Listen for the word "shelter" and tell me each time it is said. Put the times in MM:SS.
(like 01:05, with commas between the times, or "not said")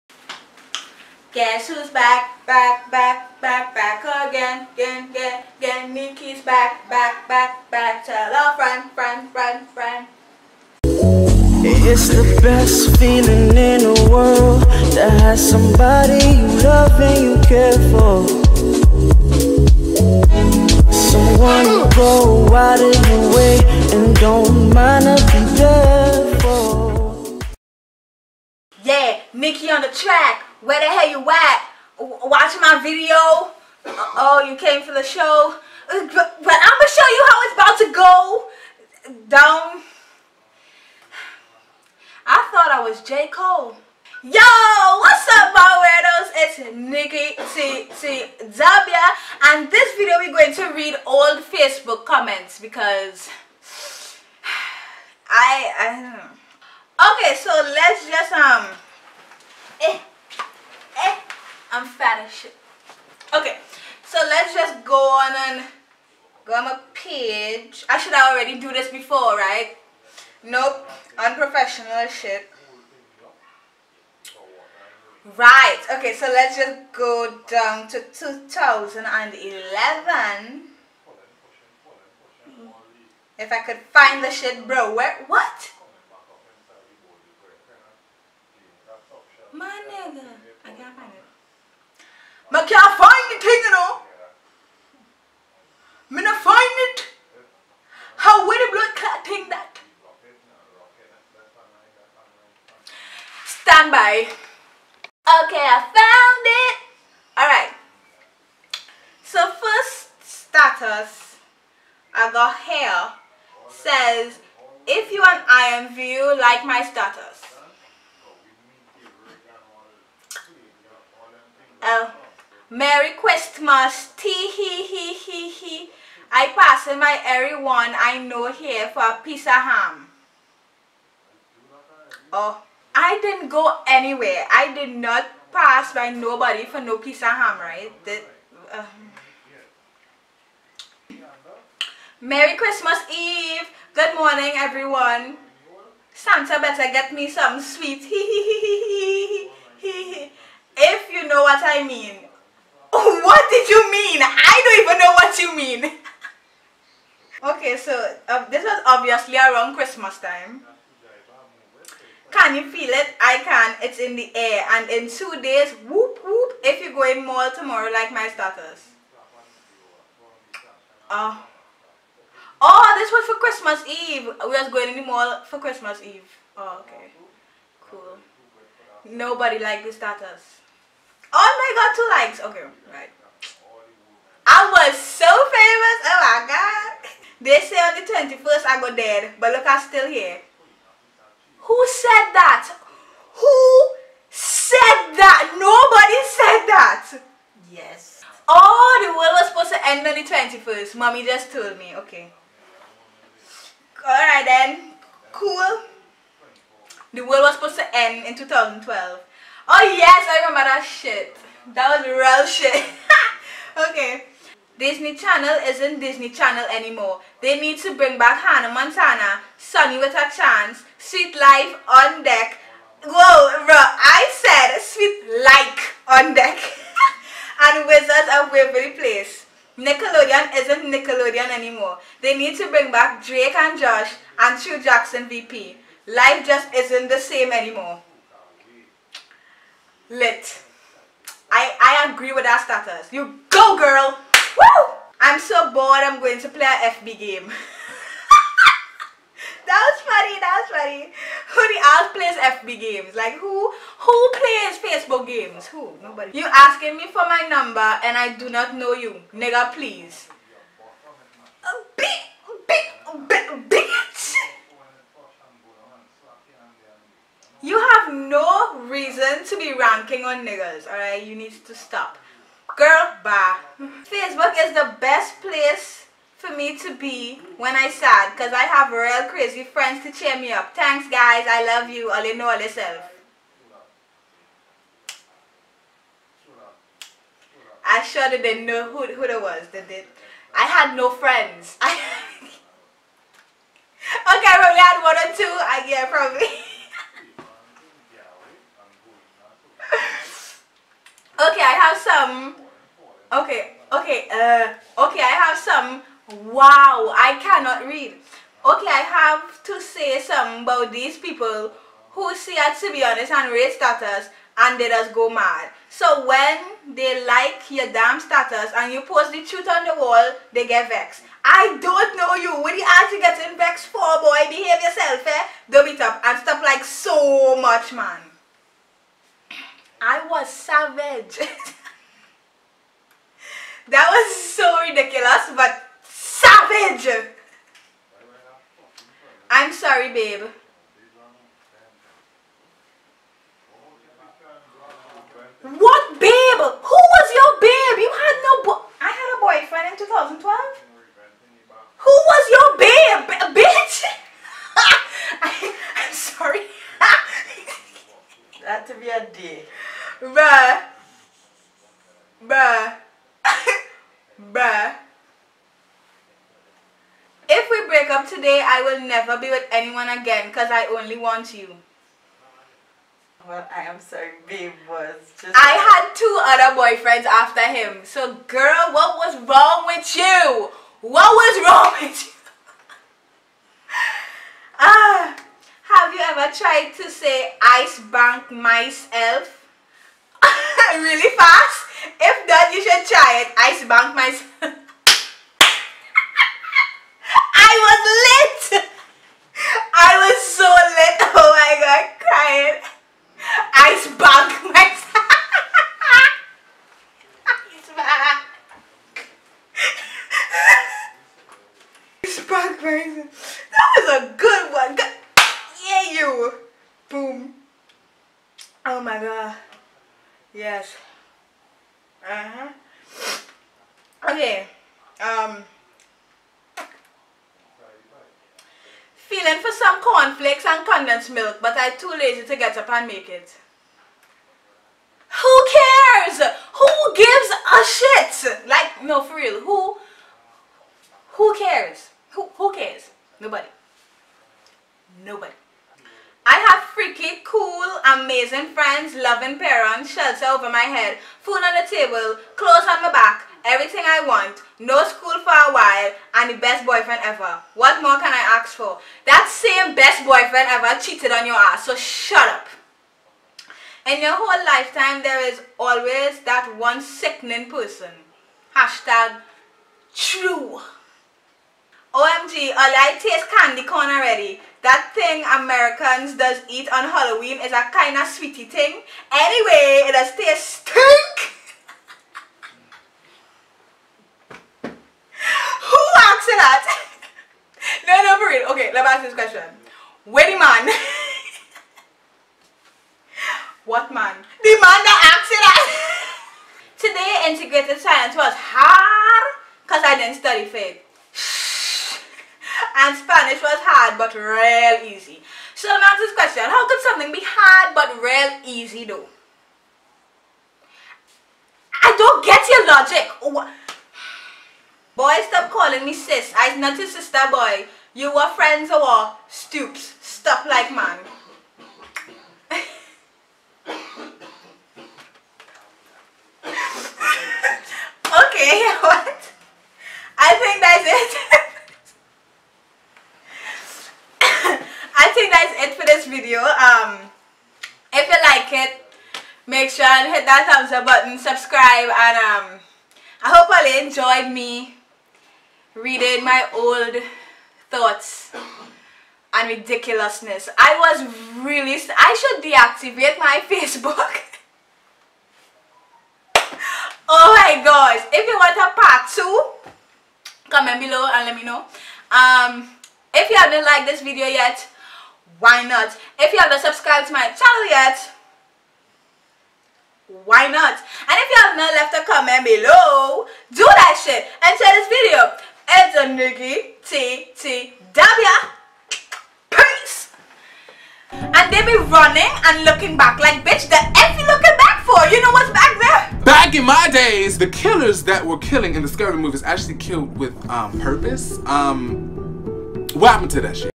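07:30.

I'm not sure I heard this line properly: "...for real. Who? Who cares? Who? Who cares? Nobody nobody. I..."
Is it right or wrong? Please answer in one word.
right.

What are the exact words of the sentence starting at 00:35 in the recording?
Uh, but I'm going to show you how it's about to go down.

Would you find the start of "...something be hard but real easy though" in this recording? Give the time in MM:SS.
08:27.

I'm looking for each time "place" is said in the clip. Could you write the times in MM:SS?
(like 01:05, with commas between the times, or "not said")
03:48, 04:35.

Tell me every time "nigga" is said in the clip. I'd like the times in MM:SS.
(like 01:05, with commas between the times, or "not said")
04:19, 04:30.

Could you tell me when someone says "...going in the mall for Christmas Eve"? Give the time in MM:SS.
02:54.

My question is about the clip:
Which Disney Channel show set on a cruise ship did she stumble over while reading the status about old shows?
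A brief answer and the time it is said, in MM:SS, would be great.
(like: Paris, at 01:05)
Sweet Life on Deck, at 03:40.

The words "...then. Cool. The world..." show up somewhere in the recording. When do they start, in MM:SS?
03:24.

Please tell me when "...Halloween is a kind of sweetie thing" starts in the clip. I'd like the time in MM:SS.
07:57.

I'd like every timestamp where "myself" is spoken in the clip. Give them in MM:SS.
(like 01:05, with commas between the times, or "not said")
06:28, 06:34.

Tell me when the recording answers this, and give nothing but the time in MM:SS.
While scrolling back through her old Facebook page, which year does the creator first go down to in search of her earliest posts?
01:18.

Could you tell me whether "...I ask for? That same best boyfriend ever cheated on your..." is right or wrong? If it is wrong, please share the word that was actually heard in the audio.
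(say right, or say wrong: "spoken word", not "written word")
right.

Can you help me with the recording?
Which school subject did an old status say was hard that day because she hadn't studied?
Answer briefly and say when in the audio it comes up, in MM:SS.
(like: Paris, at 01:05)
Integrated science, at 08:17.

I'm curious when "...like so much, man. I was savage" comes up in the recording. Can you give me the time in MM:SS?
05:26.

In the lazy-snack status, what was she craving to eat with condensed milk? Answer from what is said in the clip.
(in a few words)
Cornflakes.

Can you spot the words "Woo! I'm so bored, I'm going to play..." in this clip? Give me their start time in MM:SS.
04:04.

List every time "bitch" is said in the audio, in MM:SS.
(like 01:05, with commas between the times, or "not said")
09:43.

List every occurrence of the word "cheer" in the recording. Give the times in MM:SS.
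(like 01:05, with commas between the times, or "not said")
04:40.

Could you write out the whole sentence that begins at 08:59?
make sure and hit that thumbs up button, subscribe, and um, I hope all enjoyed me reading my old thoughts and ridiculousness.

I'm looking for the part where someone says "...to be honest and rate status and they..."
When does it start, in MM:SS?
05:12.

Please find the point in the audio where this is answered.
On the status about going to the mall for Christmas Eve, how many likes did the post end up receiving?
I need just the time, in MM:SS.
03:01.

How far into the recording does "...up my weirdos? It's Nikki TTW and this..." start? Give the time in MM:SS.
00:45.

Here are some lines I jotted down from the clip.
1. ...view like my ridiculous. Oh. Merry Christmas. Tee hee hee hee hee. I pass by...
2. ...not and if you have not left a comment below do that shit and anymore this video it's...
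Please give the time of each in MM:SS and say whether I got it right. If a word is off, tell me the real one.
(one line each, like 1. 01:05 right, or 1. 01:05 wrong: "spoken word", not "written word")
1. 01:55 wrong: "status", not "ridiculous"
2. 09:30 wrong: "share", not "anymore".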